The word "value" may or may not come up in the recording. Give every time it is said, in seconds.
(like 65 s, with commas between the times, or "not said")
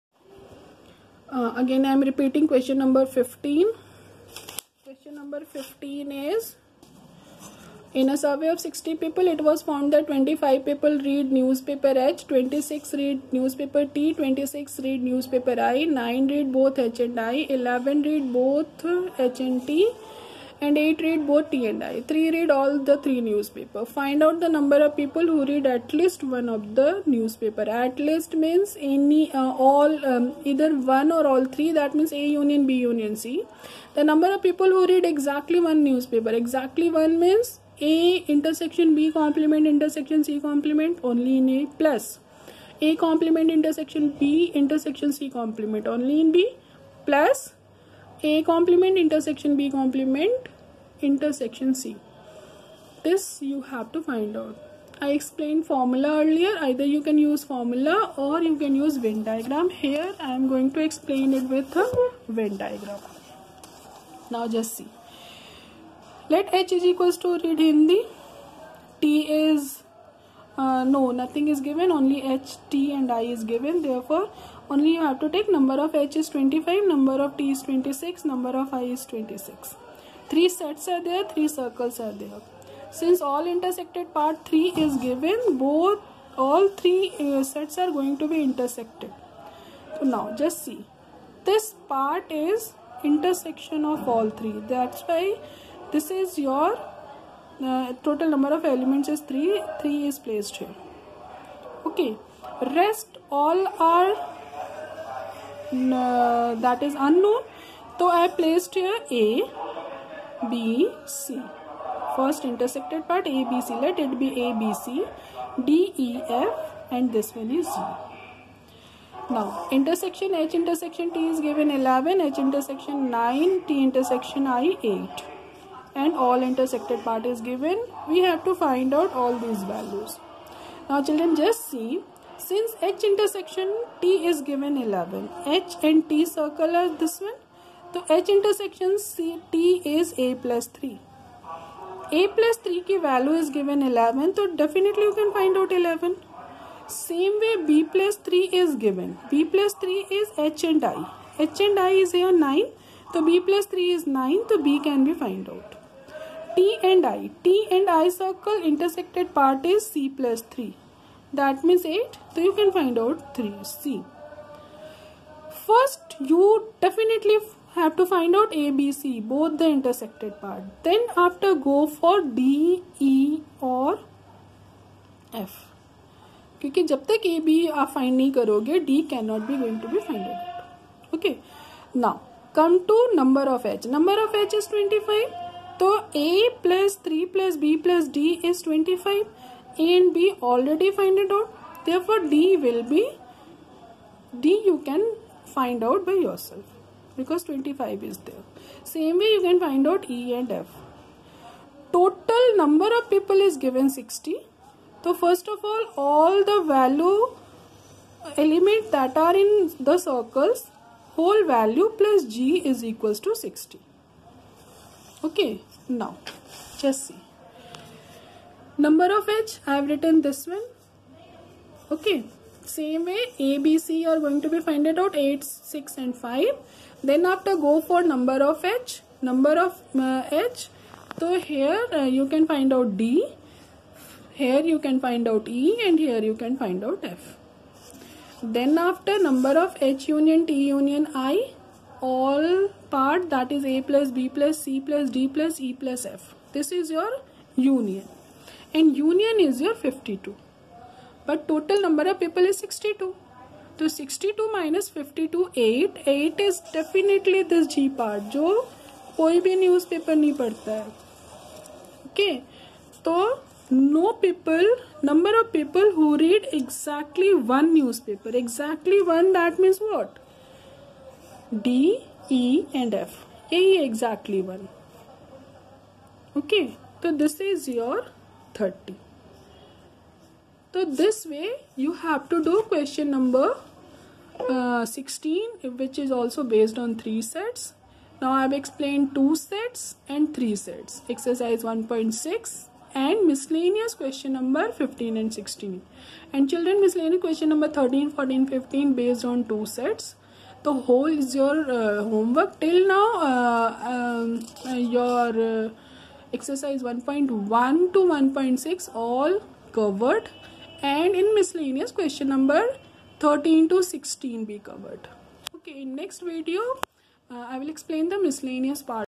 129 s, 143 s, 206 s, 211 s.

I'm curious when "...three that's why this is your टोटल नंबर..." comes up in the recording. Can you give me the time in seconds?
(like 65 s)
94 s.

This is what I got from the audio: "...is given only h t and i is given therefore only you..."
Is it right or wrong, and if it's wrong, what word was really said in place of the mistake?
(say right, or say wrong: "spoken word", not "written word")
right.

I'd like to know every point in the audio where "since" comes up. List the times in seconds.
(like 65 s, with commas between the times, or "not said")
82 s, 132 s.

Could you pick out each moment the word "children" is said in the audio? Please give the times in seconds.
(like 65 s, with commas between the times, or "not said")
131 s, 296 s.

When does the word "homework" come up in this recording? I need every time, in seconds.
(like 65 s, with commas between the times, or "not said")
302 s.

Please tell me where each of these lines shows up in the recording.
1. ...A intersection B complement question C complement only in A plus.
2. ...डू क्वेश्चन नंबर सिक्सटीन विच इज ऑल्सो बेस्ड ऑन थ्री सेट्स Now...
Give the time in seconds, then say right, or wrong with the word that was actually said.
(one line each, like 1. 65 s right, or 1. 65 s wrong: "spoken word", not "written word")
1. 37 s wrong: "intersection", not "question"
2. 282 s right.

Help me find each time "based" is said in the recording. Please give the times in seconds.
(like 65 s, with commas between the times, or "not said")
298 s.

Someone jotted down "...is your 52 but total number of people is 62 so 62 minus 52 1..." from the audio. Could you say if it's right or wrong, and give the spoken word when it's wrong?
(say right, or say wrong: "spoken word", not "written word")
wrong: "8", not "1".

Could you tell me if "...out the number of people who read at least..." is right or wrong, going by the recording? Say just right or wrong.
right.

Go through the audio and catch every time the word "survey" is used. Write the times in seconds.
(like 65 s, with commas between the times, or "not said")
8 s.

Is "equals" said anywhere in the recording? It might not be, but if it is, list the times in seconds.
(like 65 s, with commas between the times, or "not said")
66 s, 212 s.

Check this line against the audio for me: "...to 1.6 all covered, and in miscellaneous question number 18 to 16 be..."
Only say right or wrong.
wrong.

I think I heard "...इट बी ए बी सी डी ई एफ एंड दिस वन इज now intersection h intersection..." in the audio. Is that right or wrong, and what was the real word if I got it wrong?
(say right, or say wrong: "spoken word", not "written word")
right.